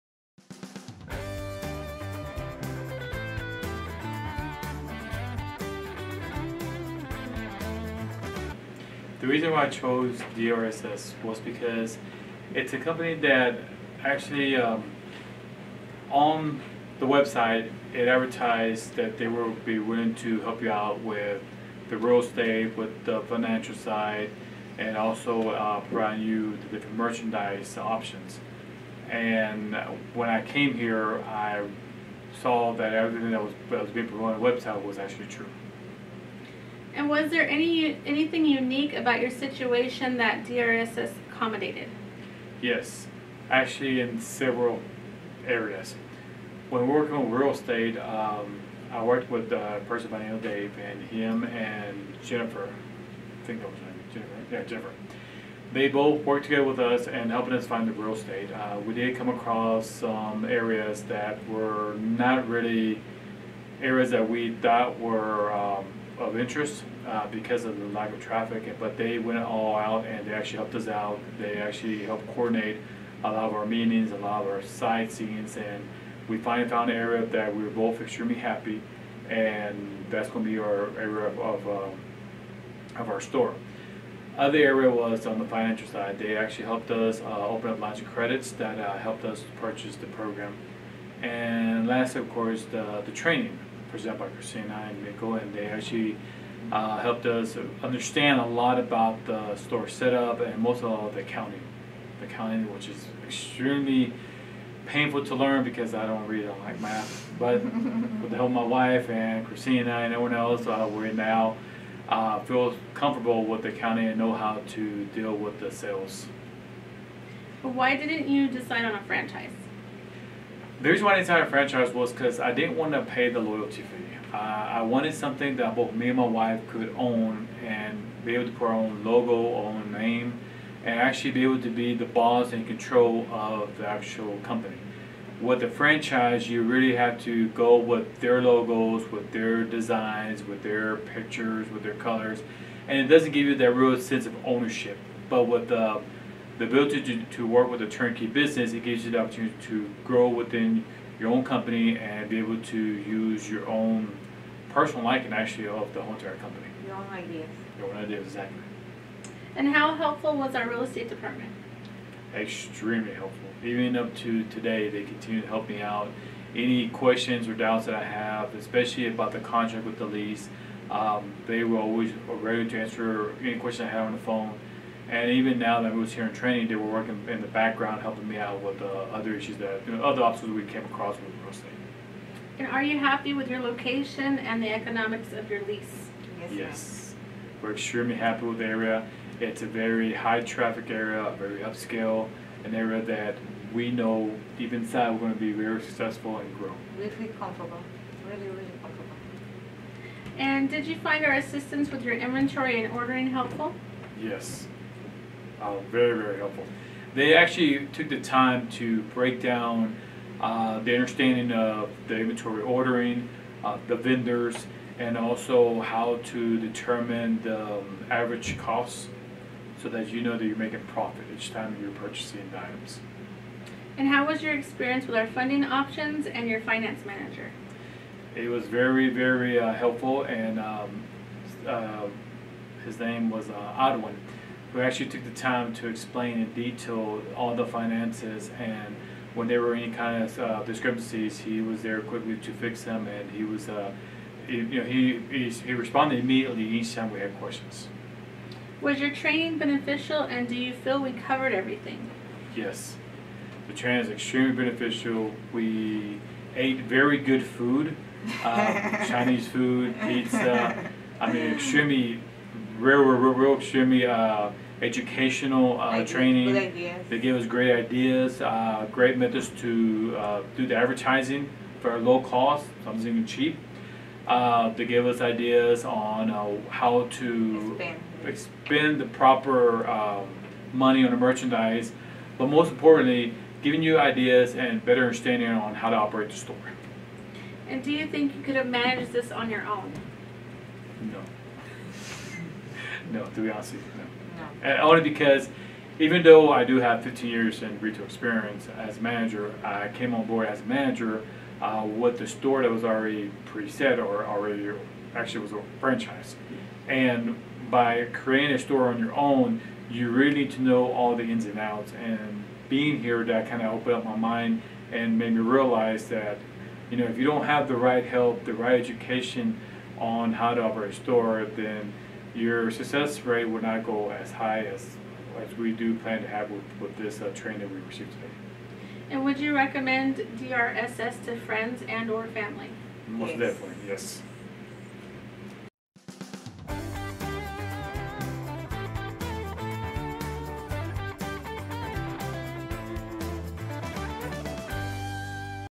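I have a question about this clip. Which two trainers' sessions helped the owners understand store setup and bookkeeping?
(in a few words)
Christina and Michael.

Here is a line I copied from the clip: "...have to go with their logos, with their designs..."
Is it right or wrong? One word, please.
right.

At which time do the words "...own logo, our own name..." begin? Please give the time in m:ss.
2:08.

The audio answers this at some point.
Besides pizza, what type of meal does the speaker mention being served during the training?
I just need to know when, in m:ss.
4:19.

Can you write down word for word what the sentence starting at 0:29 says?
And when I came here, I saw that everything that was, that was being promoted on the website was actually true.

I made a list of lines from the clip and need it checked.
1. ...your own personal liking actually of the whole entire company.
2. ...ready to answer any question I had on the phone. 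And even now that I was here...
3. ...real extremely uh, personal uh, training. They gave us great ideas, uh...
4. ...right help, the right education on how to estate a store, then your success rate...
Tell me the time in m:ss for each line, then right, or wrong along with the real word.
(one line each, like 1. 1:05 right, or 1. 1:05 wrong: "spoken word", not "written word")
1. 2:33 right
2. 2:52 right
3. 4:23 wrong: "educational", not "personal"
4. 5:17 wrong: "operate", not "estate".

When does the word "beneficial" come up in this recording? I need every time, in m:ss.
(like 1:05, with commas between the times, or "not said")
4:09, 4:14.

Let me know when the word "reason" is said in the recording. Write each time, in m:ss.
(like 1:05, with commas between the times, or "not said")
0:09, 2:00.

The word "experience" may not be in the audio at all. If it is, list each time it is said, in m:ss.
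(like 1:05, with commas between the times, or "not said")
3:44, 4:58.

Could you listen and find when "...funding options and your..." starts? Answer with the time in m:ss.
3:45.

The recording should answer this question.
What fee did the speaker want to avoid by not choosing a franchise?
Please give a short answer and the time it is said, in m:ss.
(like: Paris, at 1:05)
Loyalty fee, at 2:03.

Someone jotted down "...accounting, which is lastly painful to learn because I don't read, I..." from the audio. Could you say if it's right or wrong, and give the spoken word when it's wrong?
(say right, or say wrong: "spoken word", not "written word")
wrong: "extremely", not "lastly".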